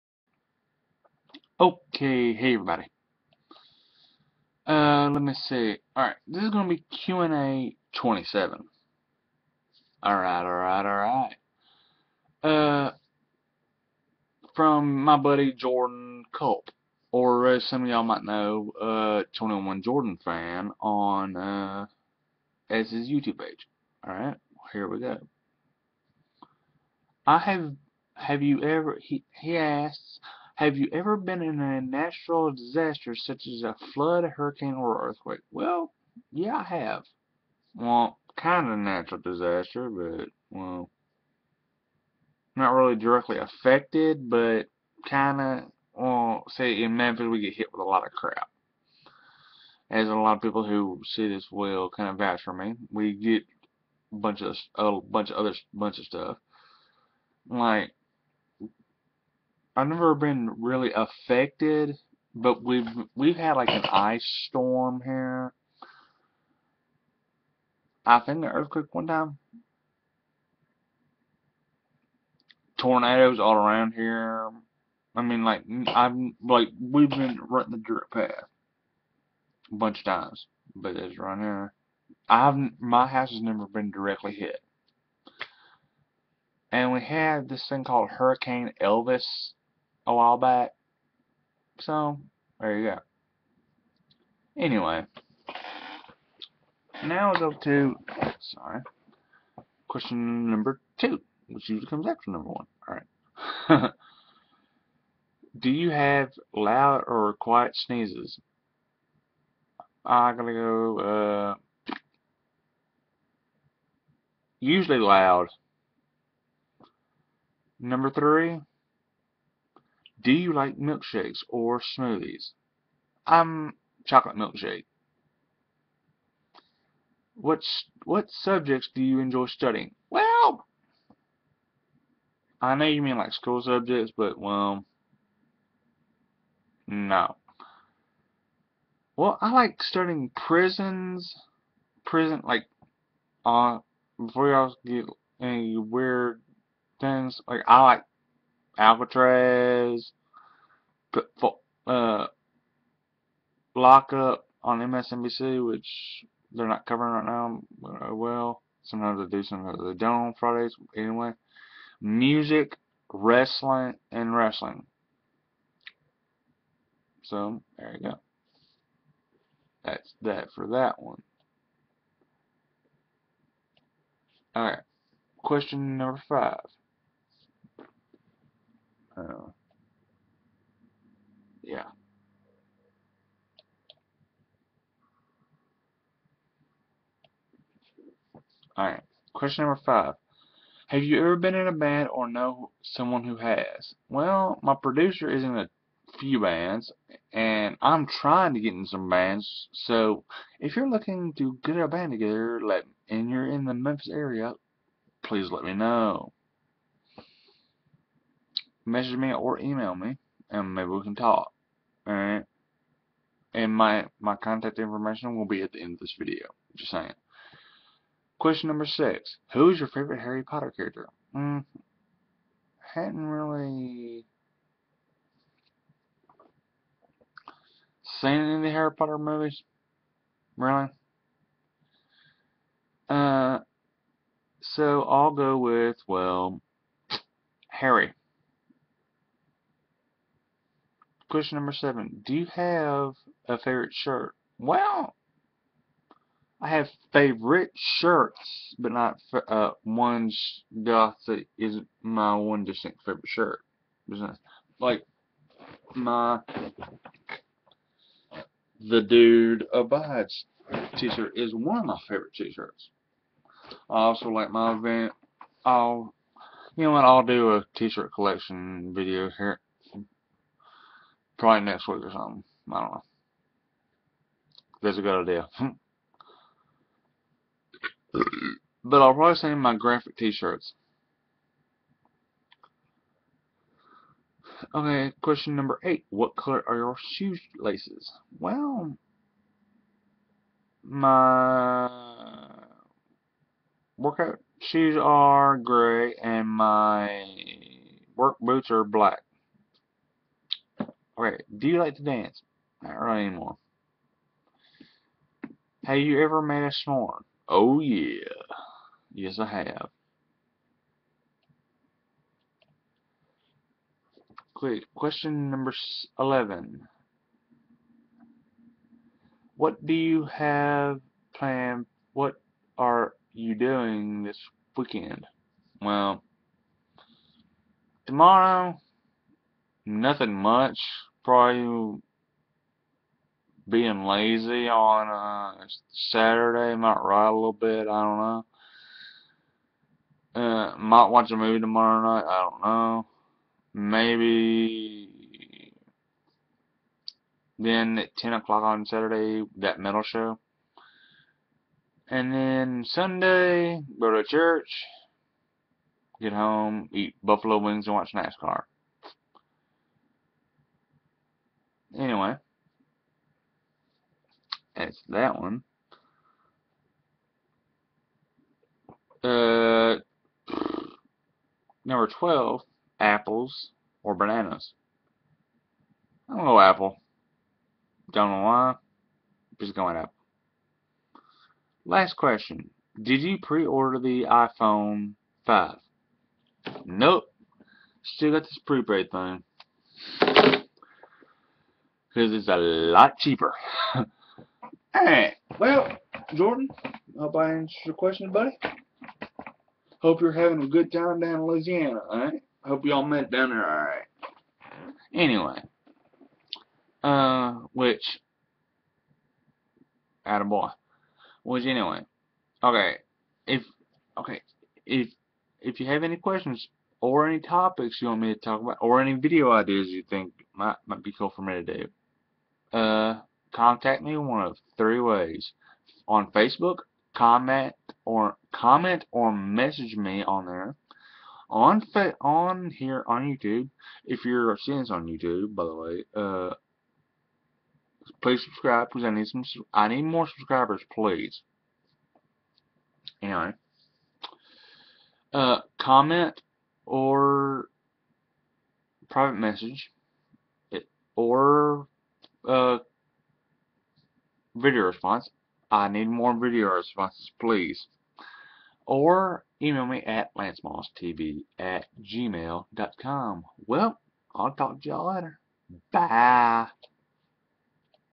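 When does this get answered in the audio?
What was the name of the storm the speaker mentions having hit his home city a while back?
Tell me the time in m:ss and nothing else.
1:28.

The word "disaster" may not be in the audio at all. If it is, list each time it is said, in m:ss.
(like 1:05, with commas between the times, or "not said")
0:32, 0:39.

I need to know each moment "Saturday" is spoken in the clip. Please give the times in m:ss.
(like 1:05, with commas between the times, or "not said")
5:36, 5:48.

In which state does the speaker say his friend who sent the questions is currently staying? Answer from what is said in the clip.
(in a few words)
Louisiana.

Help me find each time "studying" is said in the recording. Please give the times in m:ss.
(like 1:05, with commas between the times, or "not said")
2:09, 2:19.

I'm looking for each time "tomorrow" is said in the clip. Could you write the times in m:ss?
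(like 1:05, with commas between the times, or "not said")
5:28, 5:41.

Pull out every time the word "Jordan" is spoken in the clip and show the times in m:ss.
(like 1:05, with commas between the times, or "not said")
0:15, 0:19, 6:36.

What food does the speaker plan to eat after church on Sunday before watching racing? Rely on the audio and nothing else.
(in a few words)
Buffalo wings.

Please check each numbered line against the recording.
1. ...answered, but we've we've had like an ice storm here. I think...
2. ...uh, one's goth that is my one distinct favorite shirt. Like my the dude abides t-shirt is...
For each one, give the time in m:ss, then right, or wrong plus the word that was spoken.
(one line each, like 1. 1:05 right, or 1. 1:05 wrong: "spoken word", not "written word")
1. 1:00 wrong: "affected", not "answered"
2. 4:09 right.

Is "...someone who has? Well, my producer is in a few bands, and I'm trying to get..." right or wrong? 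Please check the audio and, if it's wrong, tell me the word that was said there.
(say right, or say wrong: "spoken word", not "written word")
right.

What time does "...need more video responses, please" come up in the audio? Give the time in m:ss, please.
7:35.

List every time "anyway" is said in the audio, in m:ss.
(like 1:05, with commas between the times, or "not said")
1:34, 2:40, 6:01, 6:45, 6:51, 7:23.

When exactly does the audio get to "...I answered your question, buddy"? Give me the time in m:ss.
6:37.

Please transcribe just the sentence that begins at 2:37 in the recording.
Uh, well, sometimes they do, sometimes they don't on Fridays.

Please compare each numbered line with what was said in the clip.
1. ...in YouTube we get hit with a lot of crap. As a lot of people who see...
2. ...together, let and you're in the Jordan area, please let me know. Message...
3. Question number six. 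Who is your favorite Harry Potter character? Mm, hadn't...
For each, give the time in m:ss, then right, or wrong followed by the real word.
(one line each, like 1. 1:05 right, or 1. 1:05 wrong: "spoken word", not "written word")
1. 0:46 wrong: "Memphis", not "YouTube"
2. 3:22 wrong: "Memphis", not "Jordan"
3. 3:38 right.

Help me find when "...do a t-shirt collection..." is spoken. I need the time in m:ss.
4:27.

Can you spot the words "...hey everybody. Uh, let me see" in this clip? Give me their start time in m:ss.
0:02.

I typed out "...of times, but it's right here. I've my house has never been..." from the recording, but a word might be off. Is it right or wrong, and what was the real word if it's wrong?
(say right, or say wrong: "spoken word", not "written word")
right.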